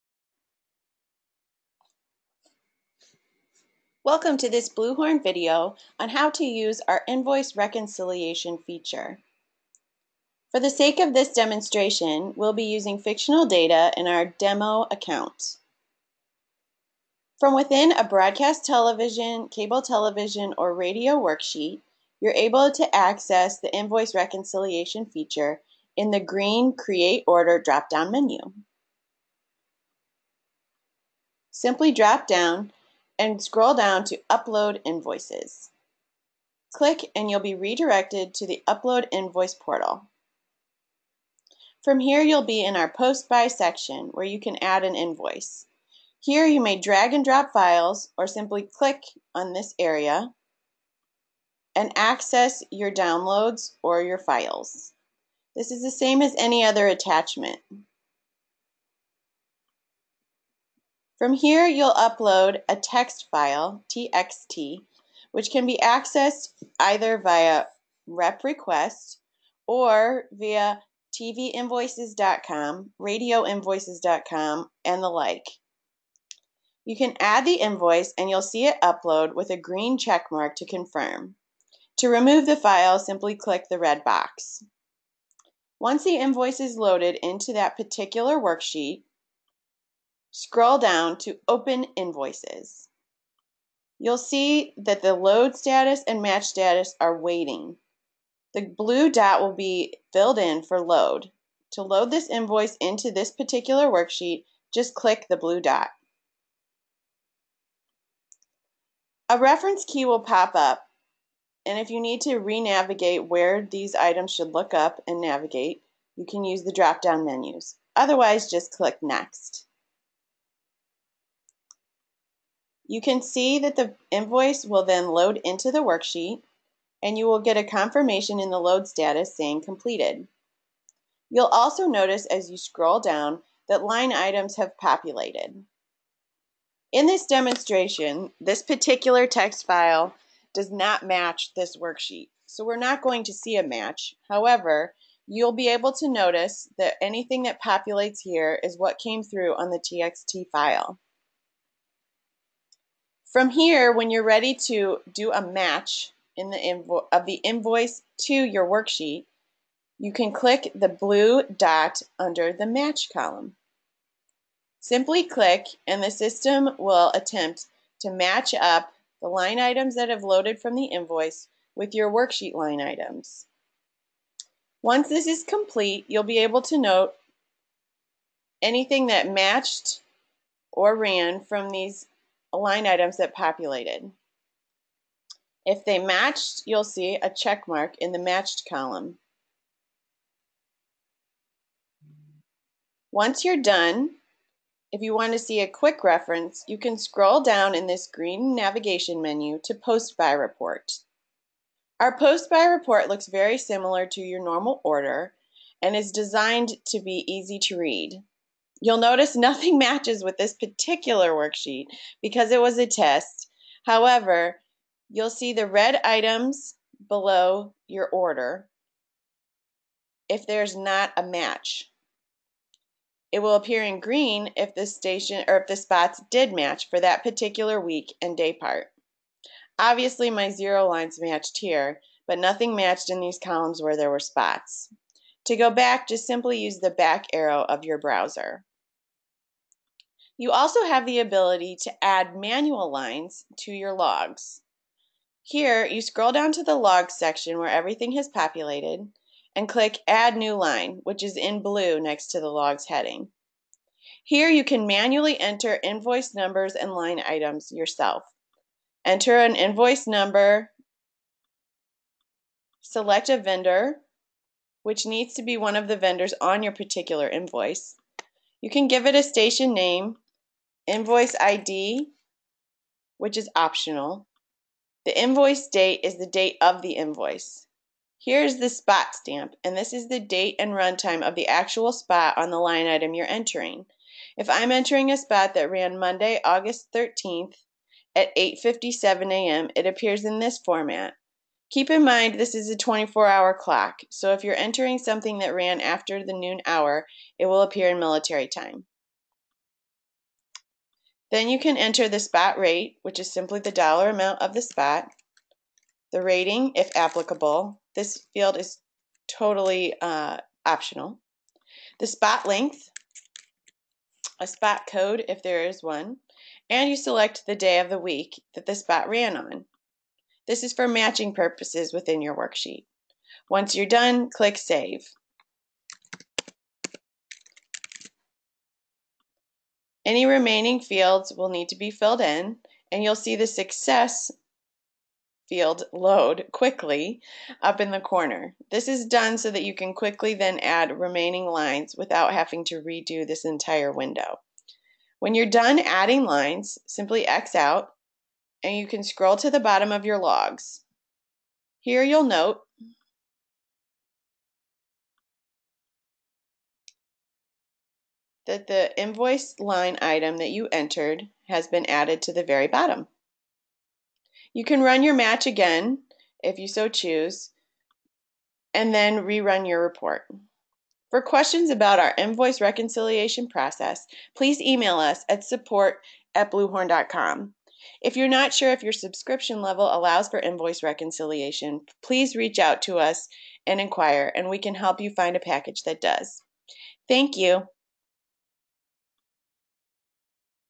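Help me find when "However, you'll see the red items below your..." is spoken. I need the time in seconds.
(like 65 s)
213 s.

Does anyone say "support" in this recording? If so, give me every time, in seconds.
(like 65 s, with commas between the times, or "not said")
375 s.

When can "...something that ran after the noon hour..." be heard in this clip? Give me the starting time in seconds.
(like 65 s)
294 s.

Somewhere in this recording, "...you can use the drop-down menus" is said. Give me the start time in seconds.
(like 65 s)
116 s.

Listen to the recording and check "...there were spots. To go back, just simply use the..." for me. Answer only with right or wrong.
right.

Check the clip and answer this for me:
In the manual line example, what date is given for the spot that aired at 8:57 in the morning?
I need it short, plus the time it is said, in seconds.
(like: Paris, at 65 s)
Monday, August 13th, at 285 s.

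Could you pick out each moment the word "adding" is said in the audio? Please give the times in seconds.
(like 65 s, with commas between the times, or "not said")
345 s.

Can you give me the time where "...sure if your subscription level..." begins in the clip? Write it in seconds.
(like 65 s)
378 s.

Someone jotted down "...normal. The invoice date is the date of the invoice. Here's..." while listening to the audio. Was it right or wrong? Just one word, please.
wrong.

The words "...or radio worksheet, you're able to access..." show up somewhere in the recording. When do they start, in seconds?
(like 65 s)
20 s.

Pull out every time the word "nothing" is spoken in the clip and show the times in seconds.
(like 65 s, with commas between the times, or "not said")
209 s, 232 s.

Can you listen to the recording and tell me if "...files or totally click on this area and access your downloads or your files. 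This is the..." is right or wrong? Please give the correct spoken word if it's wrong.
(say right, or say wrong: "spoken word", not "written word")
wrong: "simply", not "totally".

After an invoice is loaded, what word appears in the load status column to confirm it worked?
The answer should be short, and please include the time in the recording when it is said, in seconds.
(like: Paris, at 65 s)
completed, at 129 s.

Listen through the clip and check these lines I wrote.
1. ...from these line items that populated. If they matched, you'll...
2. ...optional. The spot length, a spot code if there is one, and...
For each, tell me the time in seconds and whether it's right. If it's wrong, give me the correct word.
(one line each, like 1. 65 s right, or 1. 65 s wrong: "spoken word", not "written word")
1. 181 s right
2. 310 s right.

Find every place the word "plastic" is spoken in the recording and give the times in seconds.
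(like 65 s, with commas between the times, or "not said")
not said.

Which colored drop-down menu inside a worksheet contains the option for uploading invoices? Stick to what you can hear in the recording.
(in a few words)
Create Order.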